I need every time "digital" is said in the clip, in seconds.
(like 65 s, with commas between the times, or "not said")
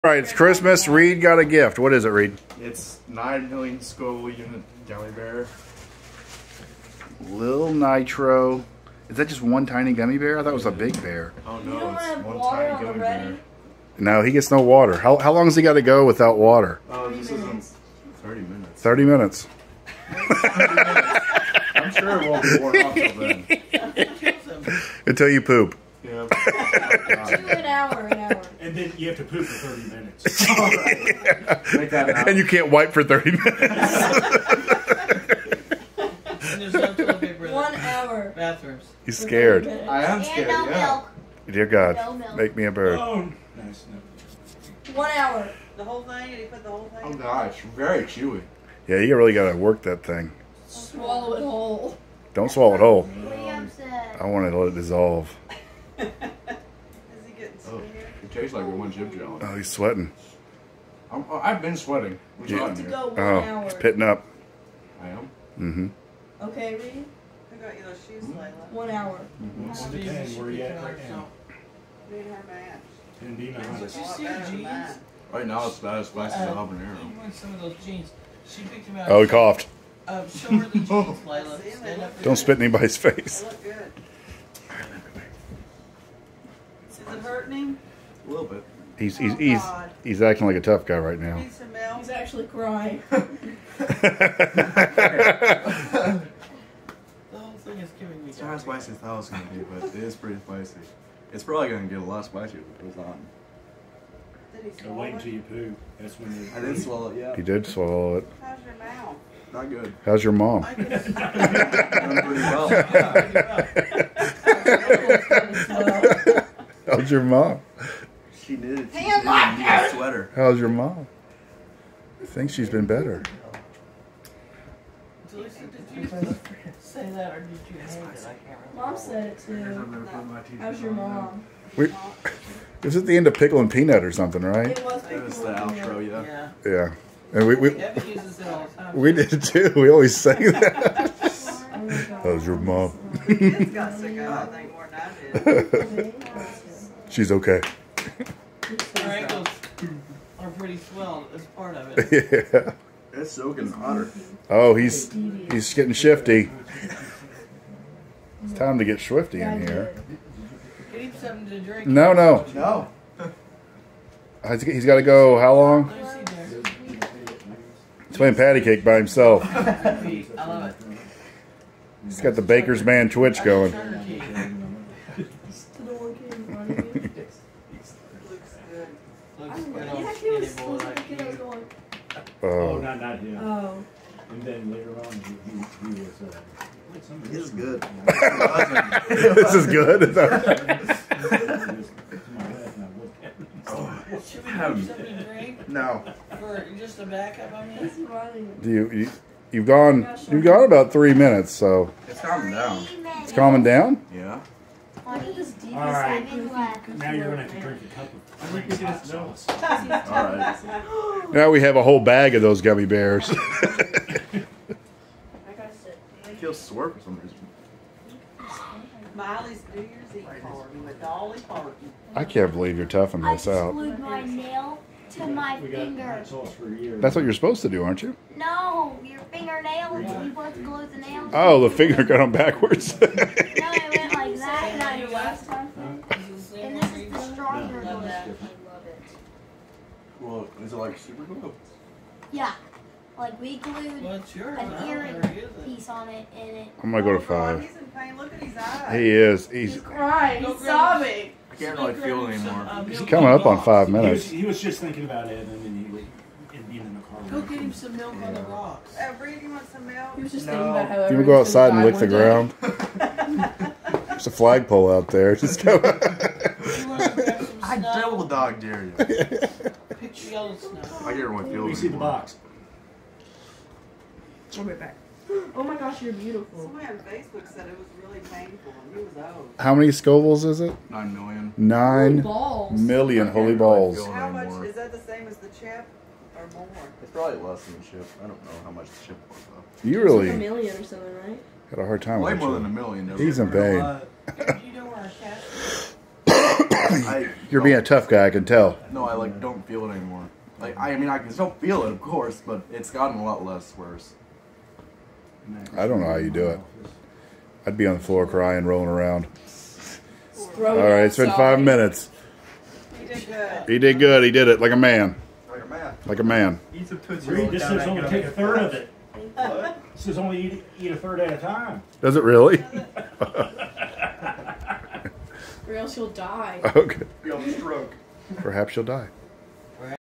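not said.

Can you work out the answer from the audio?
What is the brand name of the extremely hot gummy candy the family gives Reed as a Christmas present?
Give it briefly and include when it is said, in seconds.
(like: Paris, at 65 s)
Lil Nitro, at 7 s.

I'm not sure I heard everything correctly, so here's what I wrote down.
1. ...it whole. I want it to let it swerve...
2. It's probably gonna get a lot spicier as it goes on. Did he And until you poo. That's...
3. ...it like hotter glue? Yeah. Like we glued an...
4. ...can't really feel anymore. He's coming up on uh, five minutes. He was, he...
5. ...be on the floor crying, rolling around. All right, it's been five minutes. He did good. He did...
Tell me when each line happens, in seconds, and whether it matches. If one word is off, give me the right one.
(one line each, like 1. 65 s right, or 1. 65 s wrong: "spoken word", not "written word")
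1. 52 s wrong: "dissolve", not "swerve"
2. 101 s wrong: "Wait", not "And"
3. 240 s wrong: "super", not "hotter"
4. 251 s right
5. 307 s right.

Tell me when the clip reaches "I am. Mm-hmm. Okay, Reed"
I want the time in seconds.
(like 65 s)
65 s.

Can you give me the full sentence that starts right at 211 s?
Now we have a whole bag of those gummy bears.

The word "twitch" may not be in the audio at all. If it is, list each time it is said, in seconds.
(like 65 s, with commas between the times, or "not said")
173 s.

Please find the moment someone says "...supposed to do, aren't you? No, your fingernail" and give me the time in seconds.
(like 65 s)
227 s.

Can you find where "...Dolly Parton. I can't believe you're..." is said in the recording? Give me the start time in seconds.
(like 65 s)
221 s.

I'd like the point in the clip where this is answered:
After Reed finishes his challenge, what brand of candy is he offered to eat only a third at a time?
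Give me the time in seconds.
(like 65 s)
316 s.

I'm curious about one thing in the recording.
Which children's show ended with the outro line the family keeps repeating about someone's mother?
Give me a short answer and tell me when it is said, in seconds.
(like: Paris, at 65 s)
Pickle and Peanut, at 133 s.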